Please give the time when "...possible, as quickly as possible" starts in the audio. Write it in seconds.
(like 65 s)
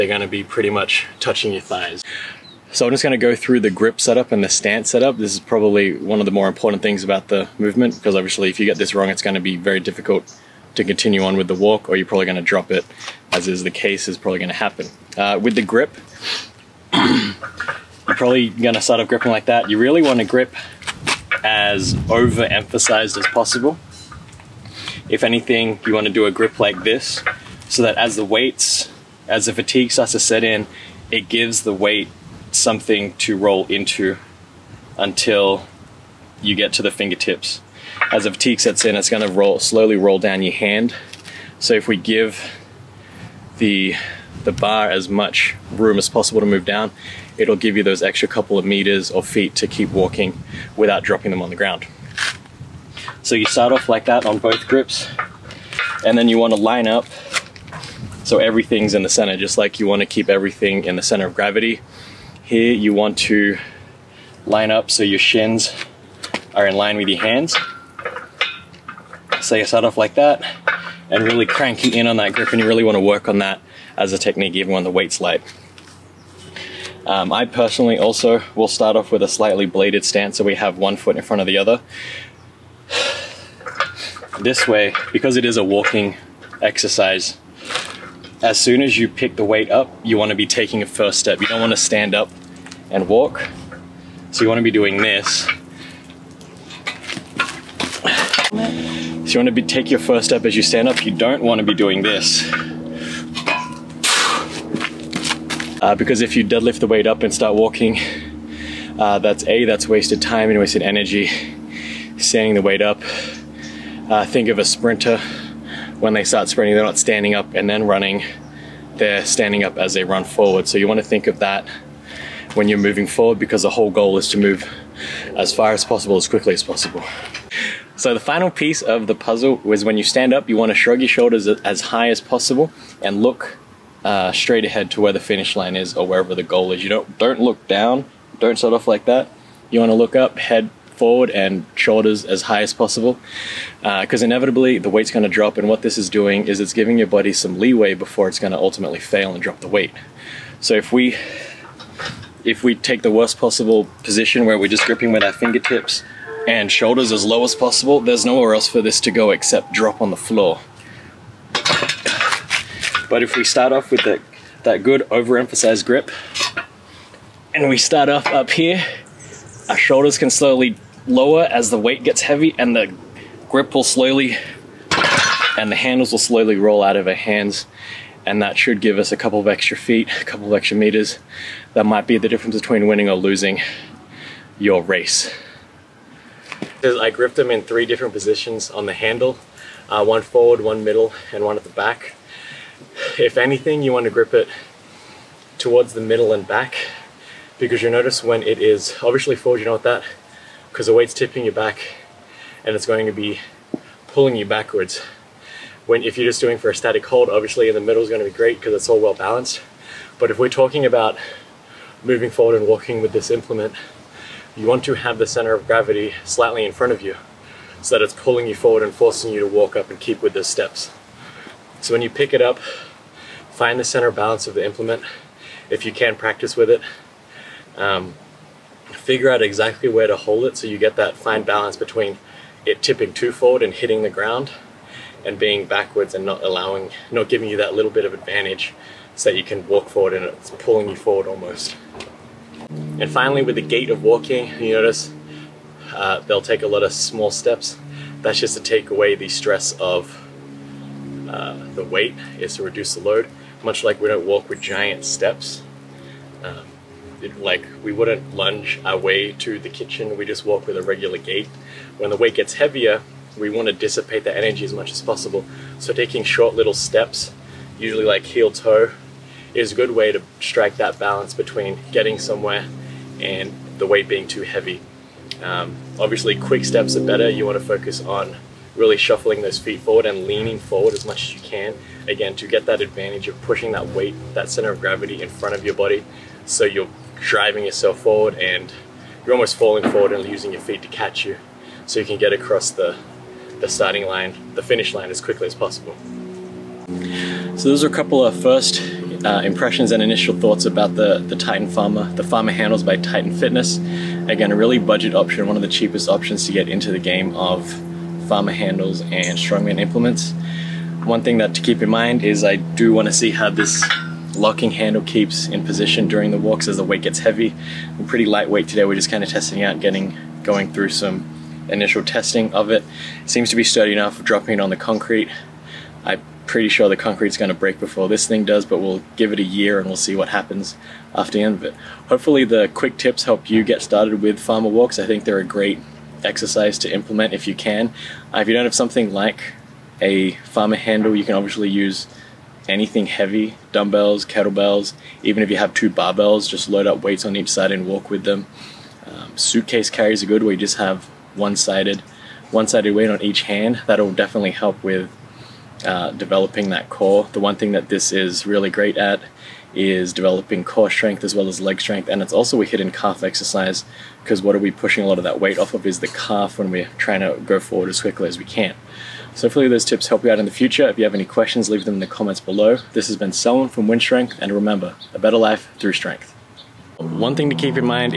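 125 s.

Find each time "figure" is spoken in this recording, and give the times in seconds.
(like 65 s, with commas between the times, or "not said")
228 s.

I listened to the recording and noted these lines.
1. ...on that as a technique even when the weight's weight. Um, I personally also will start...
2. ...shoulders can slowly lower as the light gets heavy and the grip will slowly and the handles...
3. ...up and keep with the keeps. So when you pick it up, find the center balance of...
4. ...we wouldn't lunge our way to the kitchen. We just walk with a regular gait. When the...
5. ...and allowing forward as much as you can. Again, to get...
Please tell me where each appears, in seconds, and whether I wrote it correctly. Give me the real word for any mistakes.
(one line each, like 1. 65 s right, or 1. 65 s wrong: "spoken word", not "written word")
1. 73 s wrong: "light", not "weight"
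2. 169 s wrong: "weight", not "light"
3. 219 s wrong: "steps", not "keeps"
4. 257 s right
5. 280 s wrong: "leaning", not "allowing".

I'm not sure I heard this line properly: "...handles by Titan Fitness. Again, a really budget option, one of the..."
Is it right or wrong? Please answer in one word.
right.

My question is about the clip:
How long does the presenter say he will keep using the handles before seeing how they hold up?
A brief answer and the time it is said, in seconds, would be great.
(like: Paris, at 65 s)
a year, at 329 s.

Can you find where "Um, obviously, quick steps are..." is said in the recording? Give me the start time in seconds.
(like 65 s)
275 s.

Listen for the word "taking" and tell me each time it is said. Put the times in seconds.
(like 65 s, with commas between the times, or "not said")
90 s, 265 s.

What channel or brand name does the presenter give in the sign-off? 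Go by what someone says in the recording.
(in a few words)
Wynn Strength.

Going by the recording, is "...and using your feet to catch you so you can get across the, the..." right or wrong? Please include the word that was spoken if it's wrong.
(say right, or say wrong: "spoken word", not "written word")
right.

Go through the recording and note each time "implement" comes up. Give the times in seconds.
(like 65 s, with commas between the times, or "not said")
213 s, 224 s, 309 s, 336 s.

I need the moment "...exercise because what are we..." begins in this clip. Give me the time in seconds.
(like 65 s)
363 s.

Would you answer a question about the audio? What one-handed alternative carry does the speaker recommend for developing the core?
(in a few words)
suitcase carries.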